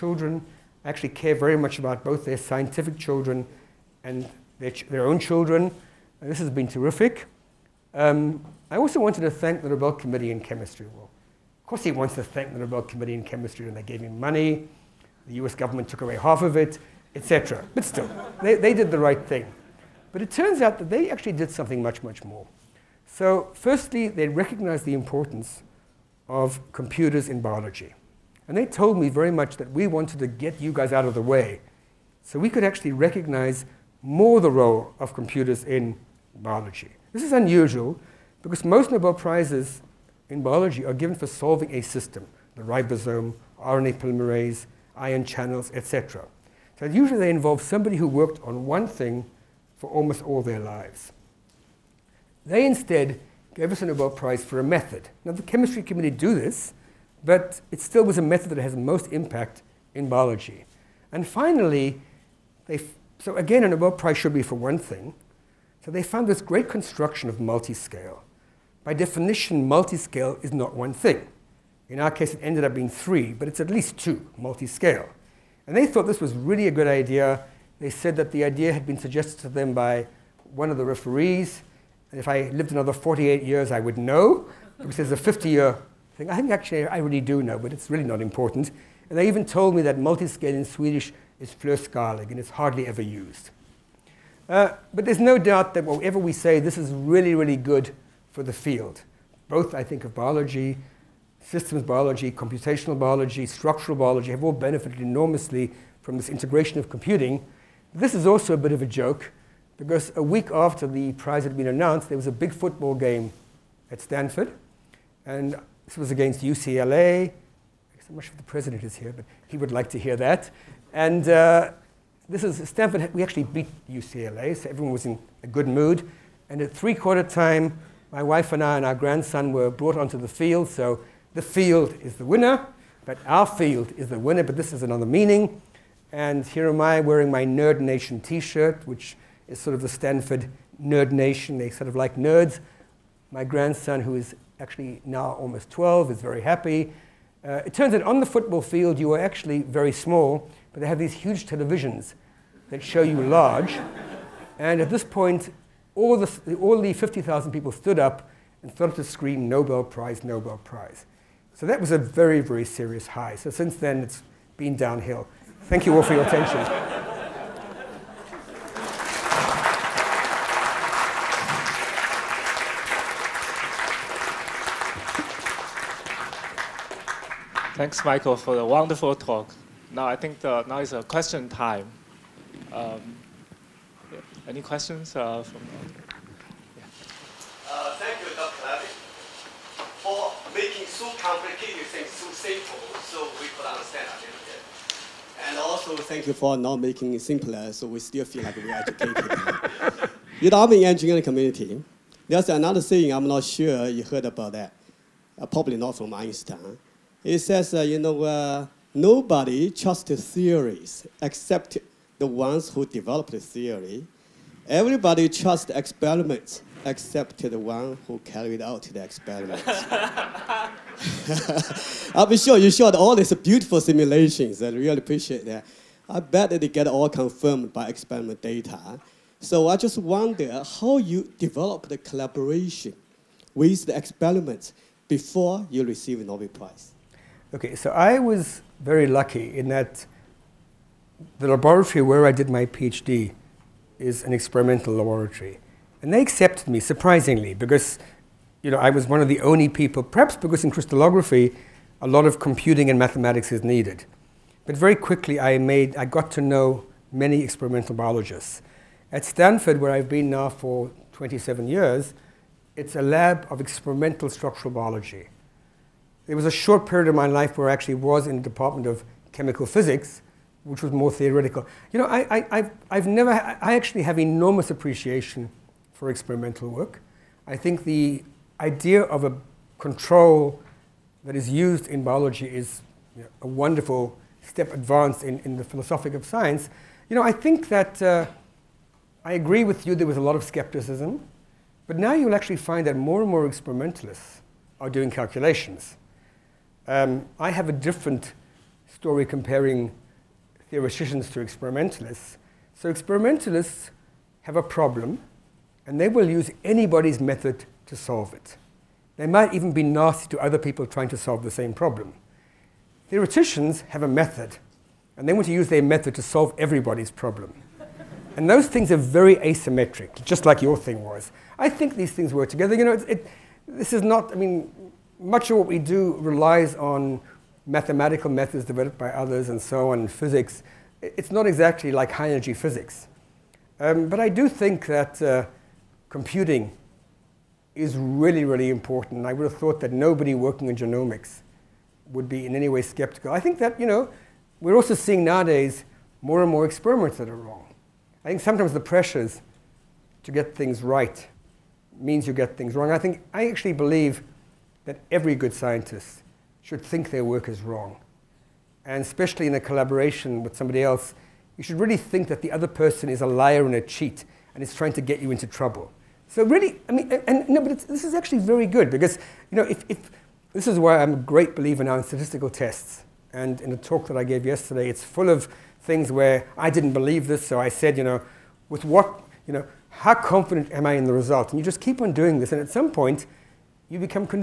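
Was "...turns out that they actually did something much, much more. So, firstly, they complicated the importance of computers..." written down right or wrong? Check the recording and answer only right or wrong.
wrong.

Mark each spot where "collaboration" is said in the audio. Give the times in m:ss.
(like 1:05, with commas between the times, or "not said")
3:51, 5:59.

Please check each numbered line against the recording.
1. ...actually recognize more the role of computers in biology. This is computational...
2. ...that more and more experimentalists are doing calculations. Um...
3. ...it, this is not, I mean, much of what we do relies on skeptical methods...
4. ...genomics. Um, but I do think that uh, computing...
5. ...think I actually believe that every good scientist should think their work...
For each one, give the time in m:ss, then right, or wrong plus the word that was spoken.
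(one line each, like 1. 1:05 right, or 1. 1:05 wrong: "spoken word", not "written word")
1. 0:32 wrong: "unusual", not "computational"
2. 4:52 right
3. 5:23 wrong: "mathematical", not "skeptical"
4. 5:32 wrong: "physics", not "genomics"
5. 5:52 right.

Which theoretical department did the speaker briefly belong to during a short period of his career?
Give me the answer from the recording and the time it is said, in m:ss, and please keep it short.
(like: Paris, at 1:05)
Department of Chemical Physics, at 4:28.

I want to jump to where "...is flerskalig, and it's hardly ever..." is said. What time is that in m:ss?
1:31.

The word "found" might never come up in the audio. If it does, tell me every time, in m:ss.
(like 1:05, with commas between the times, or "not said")
1:06.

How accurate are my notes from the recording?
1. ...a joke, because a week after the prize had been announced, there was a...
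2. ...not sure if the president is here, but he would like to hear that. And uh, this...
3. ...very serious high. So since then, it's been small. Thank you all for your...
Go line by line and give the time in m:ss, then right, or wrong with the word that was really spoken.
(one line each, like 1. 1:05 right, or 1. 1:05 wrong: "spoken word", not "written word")
1. 1:48 right
2. 1:58 right
3. 2:42 wrong: "downhill", not "small".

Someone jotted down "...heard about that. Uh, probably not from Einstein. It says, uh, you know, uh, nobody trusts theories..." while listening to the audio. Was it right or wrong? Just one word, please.
right.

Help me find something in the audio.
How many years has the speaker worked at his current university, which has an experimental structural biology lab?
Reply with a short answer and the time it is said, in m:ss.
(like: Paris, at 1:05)
27, at 4:21.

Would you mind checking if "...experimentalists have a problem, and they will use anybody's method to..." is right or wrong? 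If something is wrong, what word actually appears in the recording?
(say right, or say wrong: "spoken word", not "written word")
right.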